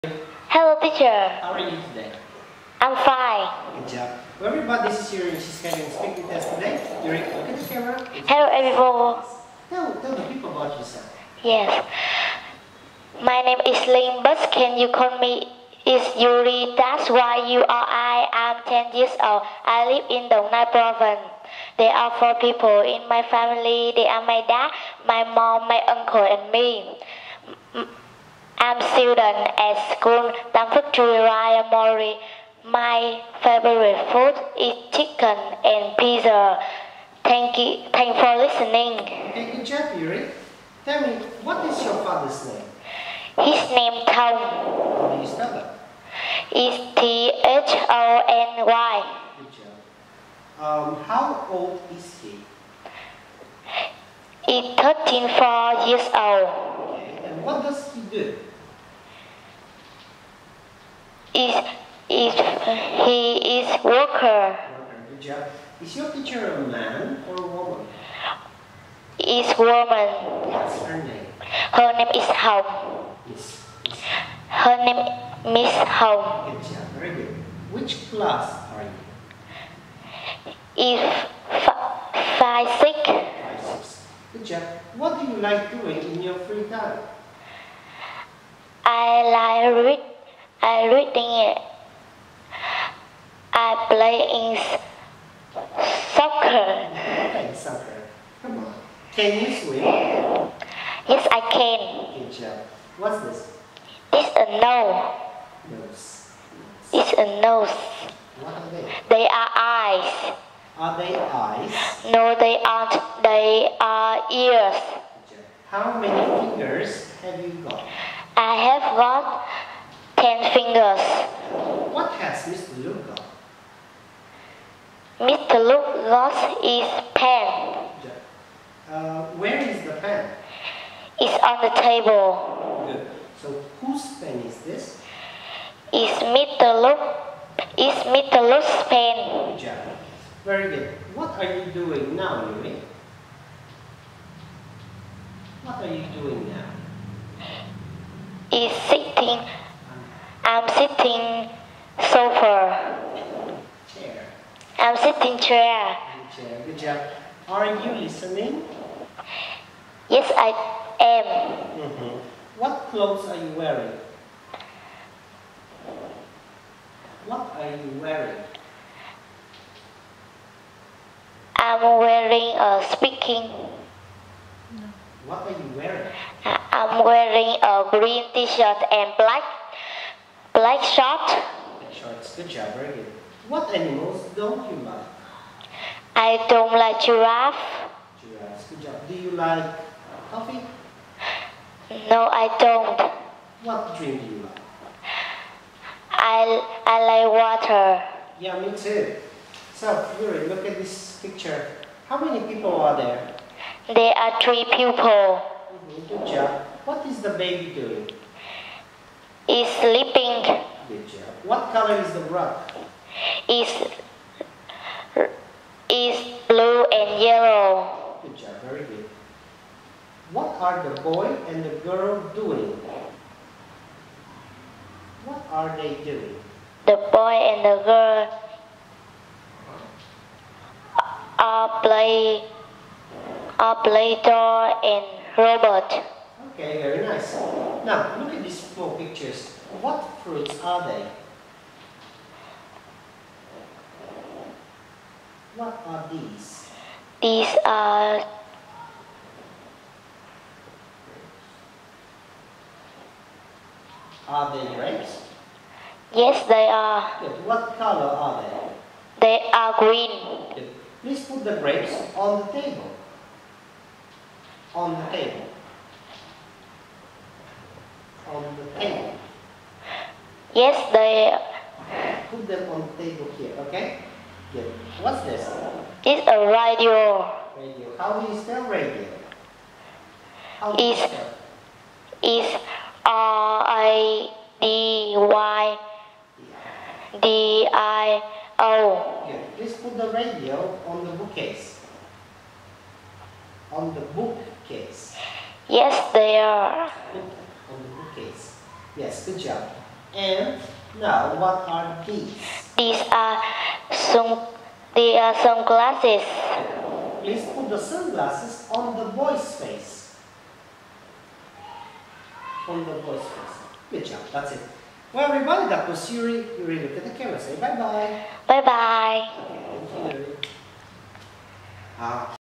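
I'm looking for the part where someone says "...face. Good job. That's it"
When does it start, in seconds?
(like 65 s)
313 s.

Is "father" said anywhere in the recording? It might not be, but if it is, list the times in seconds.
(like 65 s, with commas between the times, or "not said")
42 s.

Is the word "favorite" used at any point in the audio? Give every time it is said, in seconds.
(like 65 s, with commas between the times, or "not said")
33 s.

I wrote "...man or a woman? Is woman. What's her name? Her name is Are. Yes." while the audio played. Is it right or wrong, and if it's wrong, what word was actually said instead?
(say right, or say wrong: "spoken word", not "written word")
wrong: "How", not "Are".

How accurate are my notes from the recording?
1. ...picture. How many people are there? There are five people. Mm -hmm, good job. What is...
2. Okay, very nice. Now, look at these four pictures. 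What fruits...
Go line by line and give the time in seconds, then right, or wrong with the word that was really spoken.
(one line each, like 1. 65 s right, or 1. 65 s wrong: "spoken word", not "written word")
1. 201 s wrong: "three", not "five"
2. 236 s right.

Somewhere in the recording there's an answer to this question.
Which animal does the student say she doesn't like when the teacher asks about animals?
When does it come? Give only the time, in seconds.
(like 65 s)
187 s.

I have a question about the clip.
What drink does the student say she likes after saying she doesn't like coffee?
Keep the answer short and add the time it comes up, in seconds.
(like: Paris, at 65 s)
water, at 197 s.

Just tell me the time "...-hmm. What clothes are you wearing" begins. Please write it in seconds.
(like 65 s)
161 s.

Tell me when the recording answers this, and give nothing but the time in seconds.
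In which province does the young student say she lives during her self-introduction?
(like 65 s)
20 s.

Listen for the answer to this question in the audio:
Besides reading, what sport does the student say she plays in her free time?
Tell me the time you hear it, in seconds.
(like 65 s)
97 s.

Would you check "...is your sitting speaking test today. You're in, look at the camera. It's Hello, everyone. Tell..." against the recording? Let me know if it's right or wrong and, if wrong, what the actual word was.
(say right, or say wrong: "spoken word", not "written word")
wrong: "scheduling", not "sitting".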